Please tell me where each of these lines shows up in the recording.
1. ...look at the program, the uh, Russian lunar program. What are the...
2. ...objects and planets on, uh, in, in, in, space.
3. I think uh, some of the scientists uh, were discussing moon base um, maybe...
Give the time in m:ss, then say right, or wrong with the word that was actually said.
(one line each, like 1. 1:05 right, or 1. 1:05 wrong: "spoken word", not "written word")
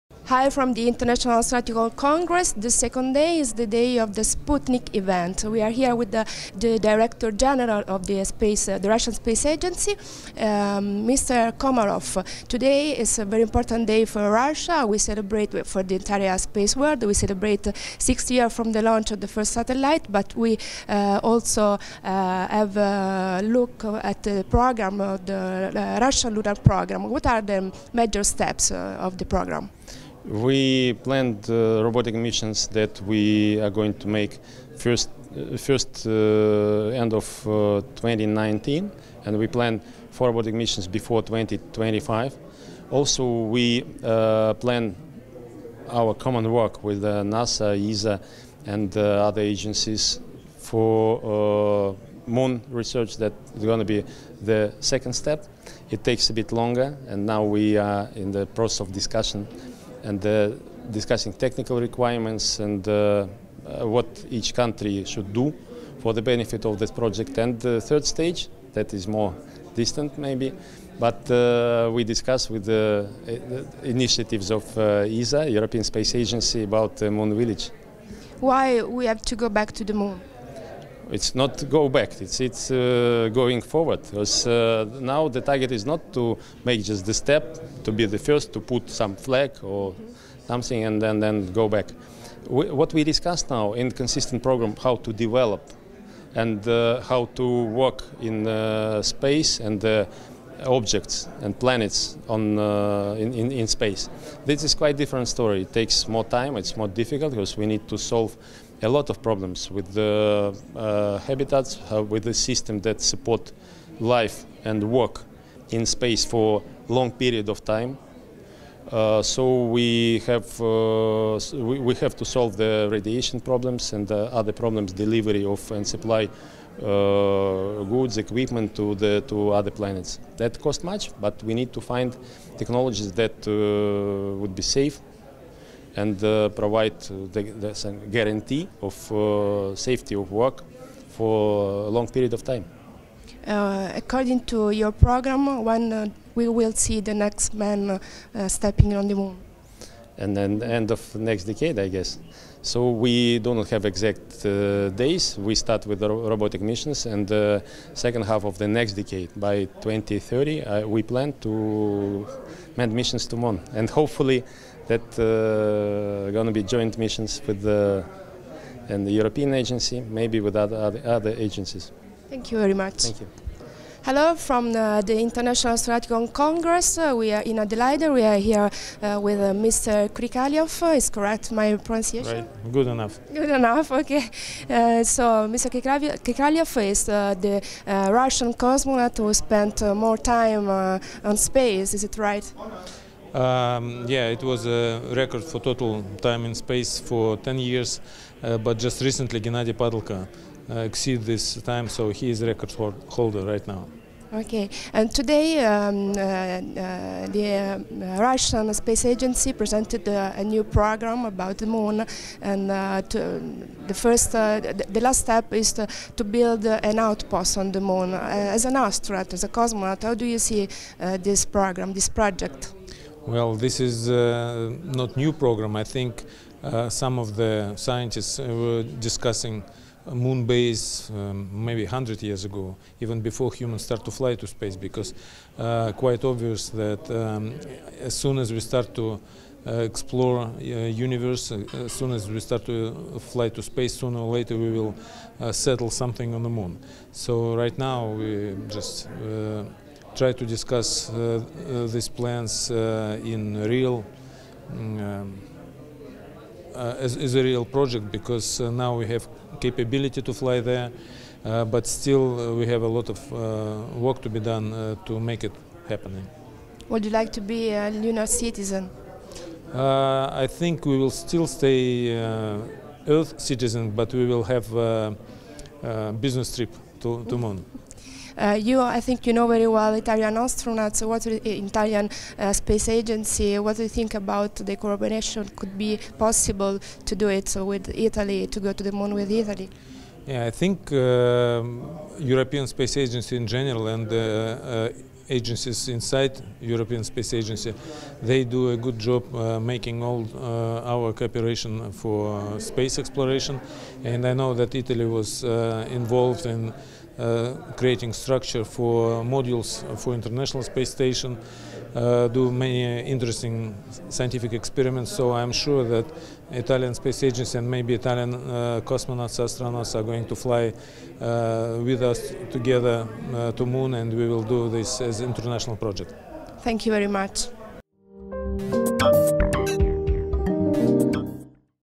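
1. 0:23 right
2. 1:40 right
3. 3:45 right.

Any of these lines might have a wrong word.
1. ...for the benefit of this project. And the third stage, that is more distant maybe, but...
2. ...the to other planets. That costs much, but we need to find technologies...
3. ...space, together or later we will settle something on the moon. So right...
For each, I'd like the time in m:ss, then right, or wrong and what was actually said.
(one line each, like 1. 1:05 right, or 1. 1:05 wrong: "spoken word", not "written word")
1. 1:05 right
2. 2:08 right
3. 4:03 wrong: "sooner", not "together".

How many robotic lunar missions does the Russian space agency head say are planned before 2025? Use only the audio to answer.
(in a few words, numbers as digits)
4.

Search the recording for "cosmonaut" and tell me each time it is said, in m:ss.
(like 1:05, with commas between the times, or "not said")
3:08, 3:39, 5:18.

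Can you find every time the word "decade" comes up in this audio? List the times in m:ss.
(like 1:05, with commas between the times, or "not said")
2:31, 2:38.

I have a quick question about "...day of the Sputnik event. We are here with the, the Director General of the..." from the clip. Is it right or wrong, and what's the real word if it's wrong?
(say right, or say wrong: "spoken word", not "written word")
right.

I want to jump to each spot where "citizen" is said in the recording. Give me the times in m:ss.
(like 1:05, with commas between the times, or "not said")
4:28, 4:33.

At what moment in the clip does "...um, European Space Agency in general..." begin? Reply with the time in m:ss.
4:50.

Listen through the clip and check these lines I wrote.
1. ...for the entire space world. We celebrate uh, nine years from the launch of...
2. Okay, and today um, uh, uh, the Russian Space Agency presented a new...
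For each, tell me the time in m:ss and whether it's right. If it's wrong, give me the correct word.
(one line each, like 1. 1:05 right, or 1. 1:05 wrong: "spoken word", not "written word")
1. 0:15 wrong: "six", not "nine"
2. 3:24 right.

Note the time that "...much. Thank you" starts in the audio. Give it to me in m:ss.
2:52.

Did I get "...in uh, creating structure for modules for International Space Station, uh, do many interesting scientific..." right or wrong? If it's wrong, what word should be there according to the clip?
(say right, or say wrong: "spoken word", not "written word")
right.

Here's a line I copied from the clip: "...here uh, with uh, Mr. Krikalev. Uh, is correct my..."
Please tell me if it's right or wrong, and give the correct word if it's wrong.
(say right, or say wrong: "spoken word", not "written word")
right.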